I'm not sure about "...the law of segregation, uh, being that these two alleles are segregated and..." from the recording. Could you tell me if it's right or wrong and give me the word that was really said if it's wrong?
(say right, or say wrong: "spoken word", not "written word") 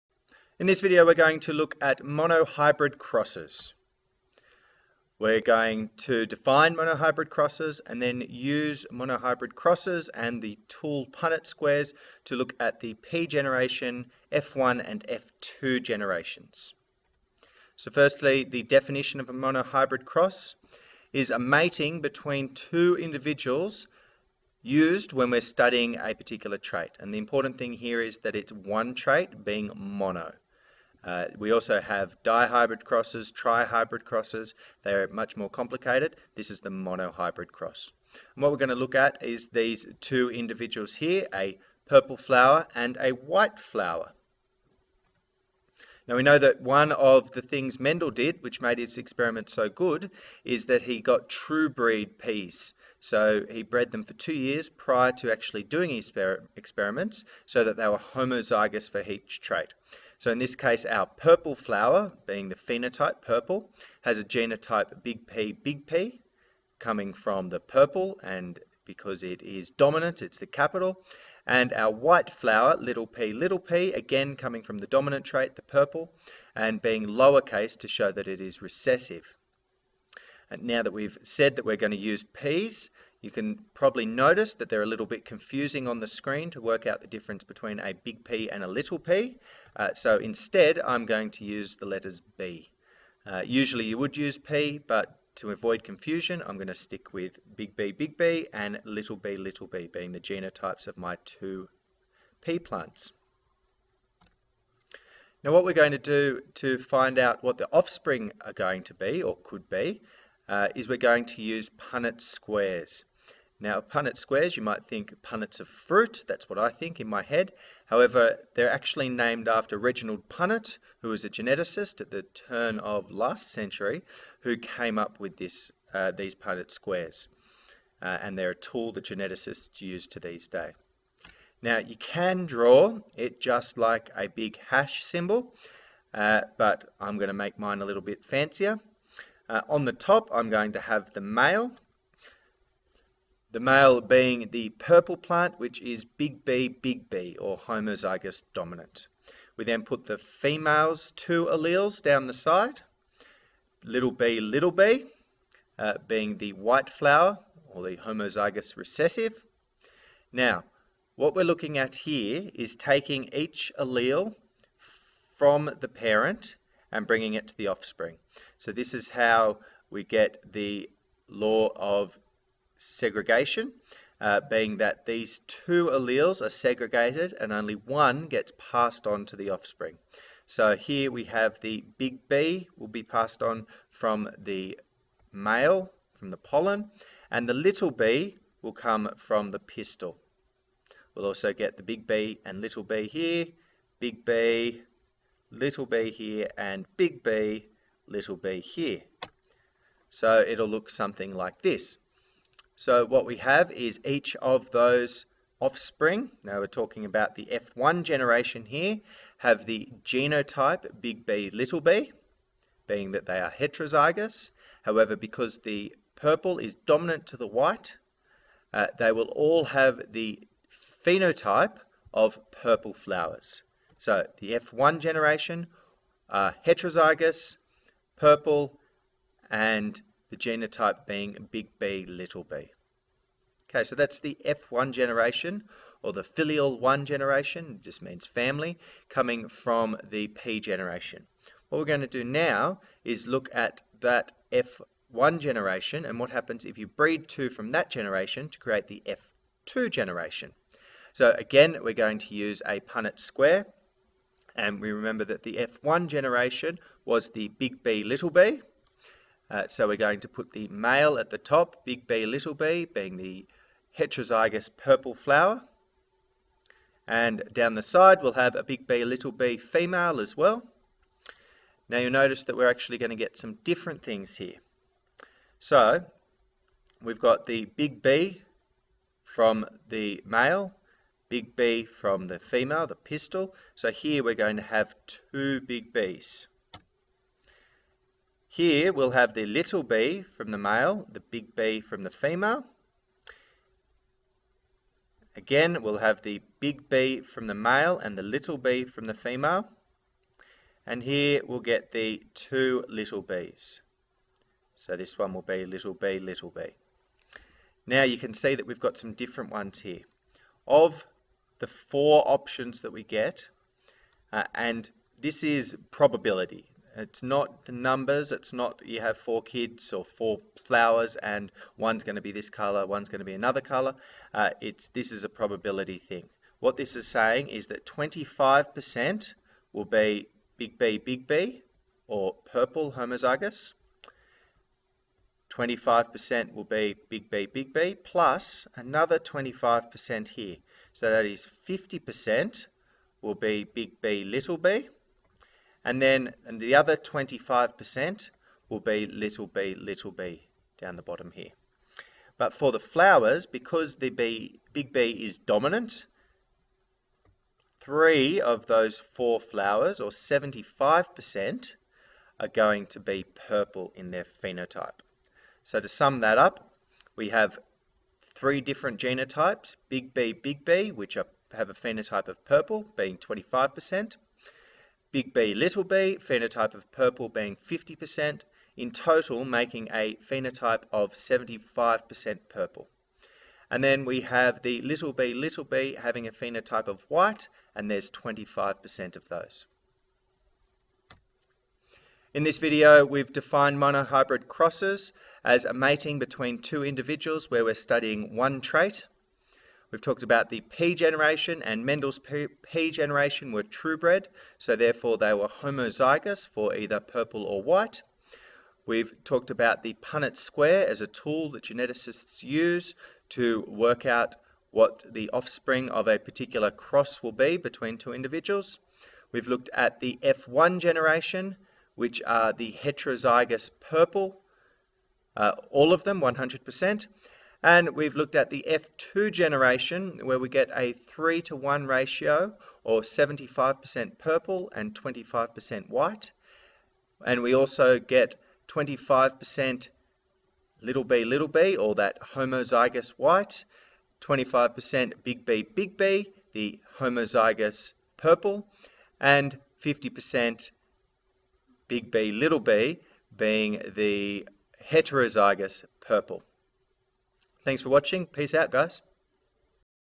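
right.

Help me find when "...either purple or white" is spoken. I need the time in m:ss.
6:46.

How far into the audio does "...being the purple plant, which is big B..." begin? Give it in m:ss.
2:23.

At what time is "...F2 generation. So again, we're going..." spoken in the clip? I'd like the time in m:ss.
4:09.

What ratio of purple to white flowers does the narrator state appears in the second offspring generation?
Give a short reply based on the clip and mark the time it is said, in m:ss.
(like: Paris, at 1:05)
3 to 1, at 7:10.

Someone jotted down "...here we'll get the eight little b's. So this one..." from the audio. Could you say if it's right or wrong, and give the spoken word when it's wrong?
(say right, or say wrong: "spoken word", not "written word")
wrong: "two", not "eight".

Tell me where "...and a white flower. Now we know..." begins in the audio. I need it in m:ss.
0:42.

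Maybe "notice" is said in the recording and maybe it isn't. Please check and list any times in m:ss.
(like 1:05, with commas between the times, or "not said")
1:24, 4:32.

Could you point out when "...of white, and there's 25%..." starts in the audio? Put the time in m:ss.
6:26.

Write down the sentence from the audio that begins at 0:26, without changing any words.
And the important thing here is that it's one trait being mono.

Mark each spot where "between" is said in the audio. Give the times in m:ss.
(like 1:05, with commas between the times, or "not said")
0:22, 1:27, 6:36, 6:57.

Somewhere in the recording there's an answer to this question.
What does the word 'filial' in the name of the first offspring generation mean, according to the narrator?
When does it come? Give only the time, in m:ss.
3:58.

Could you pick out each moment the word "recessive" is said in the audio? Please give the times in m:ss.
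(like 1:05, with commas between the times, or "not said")
1:18, 2:38.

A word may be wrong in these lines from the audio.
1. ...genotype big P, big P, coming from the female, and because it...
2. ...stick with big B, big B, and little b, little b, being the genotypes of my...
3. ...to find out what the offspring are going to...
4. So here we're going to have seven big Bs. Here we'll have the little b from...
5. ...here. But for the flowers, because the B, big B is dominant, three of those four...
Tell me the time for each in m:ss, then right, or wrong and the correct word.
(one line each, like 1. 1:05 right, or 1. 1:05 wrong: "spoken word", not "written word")
1. 1:04 wrong: "purple", not "female"
2. 1:36 right
3. 1:46 right
4. 4:43 wrong: "two", not "seven"
5. 5:51 right.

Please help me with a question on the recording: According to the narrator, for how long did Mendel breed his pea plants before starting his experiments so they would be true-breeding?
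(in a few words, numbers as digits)
2 years.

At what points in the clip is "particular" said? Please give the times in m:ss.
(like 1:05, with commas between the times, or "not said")
0:26, 6:56.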